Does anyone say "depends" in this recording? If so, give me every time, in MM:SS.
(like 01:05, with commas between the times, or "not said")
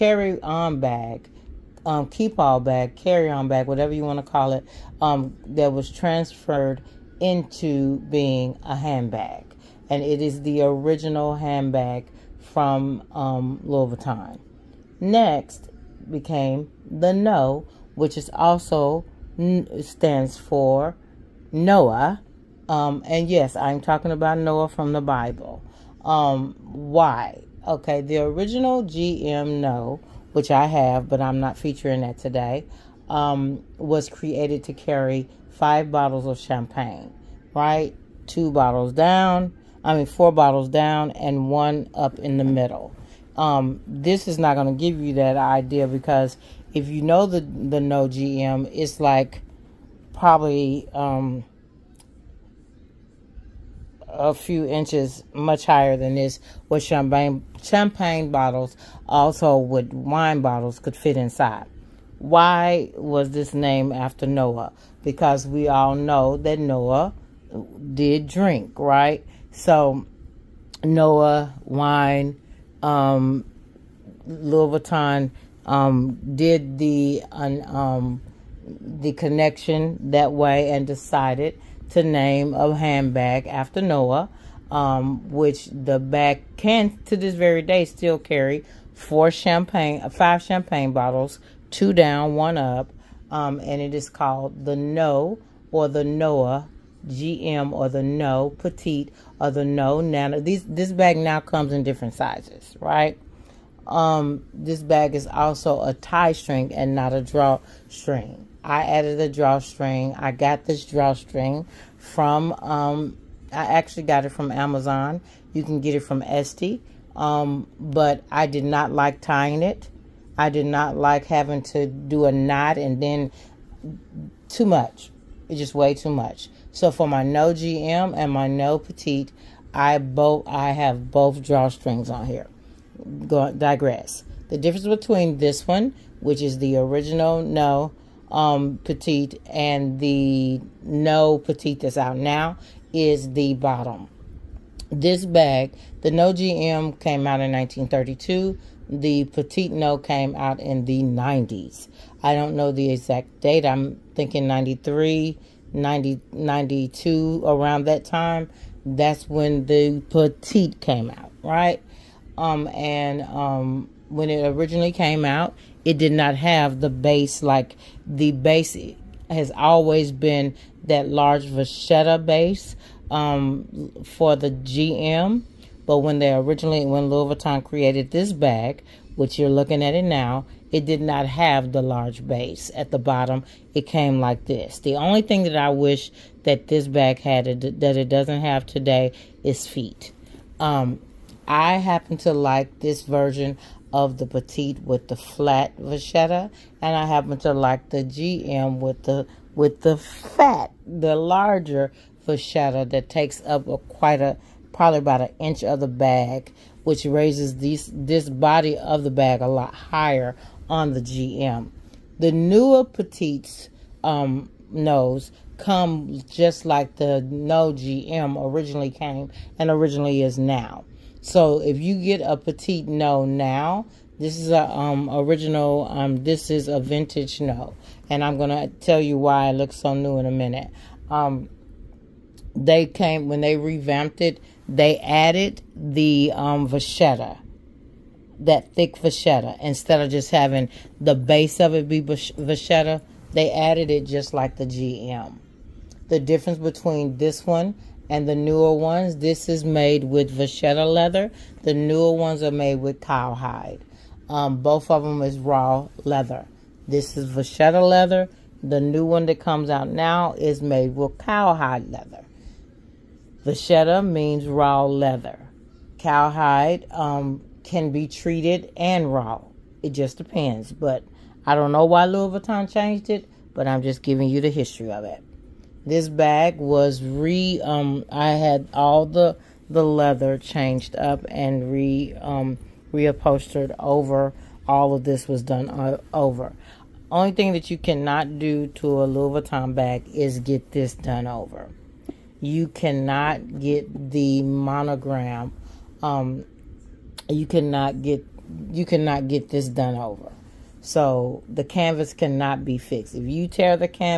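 04:30.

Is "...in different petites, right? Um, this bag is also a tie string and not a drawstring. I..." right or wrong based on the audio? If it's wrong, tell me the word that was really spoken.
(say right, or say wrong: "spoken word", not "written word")
wrong: "sizes", not "petites".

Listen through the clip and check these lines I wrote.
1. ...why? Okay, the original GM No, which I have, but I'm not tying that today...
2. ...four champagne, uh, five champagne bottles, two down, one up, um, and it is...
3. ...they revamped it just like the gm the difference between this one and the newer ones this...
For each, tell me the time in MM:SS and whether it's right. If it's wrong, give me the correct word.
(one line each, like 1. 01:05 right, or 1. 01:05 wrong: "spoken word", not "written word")
1. 00:26 wrong: "featuring", not "tying"
2. 01:28 right
3. 04:03 wrong: "added", not "revamped".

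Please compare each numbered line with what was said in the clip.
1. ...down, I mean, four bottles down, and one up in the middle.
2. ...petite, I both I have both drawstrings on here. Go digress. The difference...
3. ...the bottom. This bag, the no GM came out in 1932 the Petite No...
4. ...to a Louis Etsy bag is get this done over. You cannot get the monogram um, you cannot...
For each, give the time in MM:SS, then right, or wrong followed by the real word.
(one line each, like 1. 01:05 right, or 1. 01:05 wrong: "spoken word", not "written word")
1. 00:38 right
2. 02:08 right
3. 02:23 right
4. 04:48 wrong: "Vuitton", not "Etsy".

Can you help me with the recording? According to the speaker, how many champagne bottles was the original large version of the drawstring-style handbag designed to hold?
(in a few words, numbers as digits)
5.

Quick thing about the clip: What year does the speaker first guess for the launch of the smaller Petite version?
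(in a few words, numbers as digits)
93.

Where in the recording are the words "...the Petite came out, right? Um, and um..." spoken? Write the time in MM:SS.
02:39.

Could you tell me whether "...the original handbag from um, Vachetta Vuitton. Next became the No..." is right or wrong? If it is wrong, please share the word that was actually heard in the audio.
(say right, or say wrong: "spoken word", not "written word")
wrong: "Louis", not "Vachetta".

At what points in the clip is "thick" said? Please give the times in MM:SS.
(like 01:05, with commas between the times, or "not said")
03:58.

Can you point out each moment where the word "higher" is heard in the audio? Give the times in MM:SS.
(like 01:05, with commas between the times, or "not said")
00:55, 03:29.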